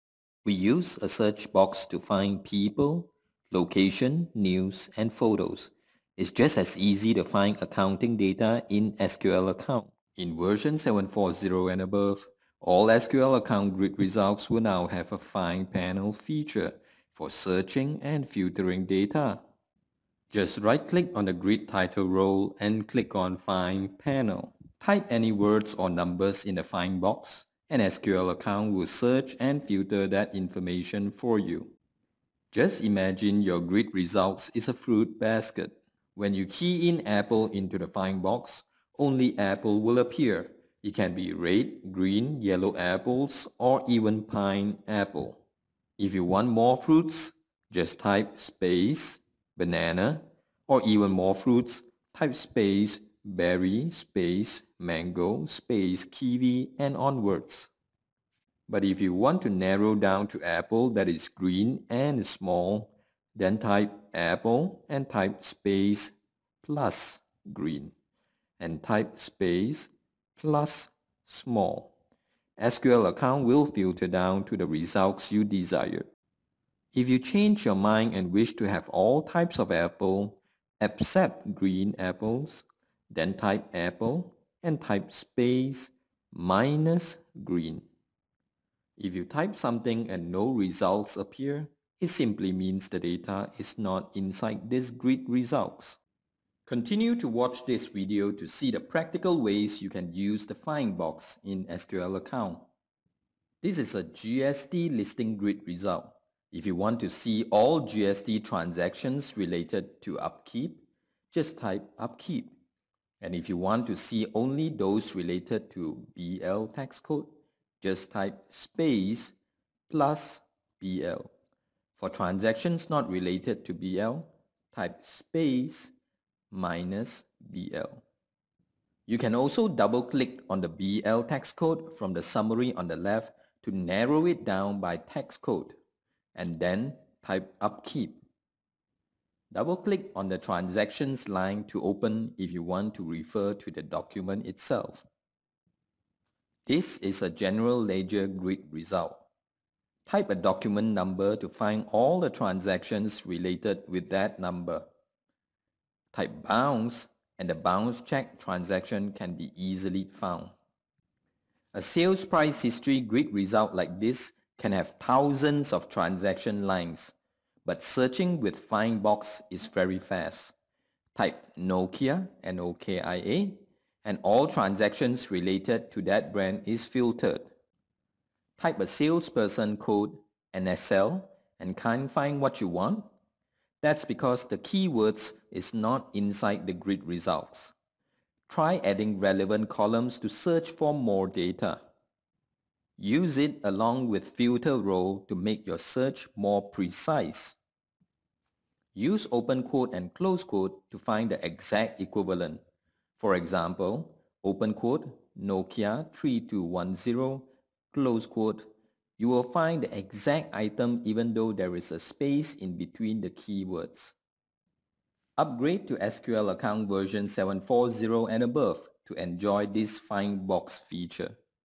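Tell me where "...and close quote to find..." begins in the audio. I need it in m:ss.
3:19.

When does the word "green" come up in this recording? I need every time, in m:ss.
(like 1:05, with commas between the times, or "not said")
0:41, 1:01, 1:07, 1:21, 1:27.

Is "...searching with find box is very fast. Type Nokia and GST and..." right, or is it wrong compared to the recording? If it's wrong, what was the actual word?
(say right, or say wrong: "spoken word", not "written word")
wrong: "OKIA", not "GST".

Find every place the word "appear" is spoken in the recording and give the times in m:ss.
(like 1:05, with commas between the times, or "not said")
0:39, 1:31.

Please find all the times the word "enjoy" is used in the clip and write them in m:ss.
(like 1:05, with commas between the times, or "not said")
3:39.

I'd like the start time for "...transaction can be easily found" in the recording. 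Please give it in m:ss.
2:38.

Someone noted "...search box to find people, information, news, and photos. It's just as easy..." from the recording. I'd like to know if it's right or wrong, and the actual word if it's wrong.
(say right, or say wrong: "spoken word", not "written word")
wrong: "location", not "information".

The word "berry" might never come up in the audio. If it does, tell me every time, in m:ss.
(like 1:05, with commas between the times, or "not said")
0:53.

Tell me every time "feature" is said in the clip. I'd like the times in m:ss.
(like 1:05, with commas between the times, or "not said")
0:16, 3:40.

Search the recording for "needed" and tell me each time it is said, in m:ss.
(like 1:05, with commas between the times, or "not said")
not said.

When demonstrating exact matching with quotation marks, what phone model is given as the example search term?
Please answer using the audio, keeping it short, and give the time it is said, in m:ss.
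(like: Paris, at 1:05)
Nokia 3210, at 3:25.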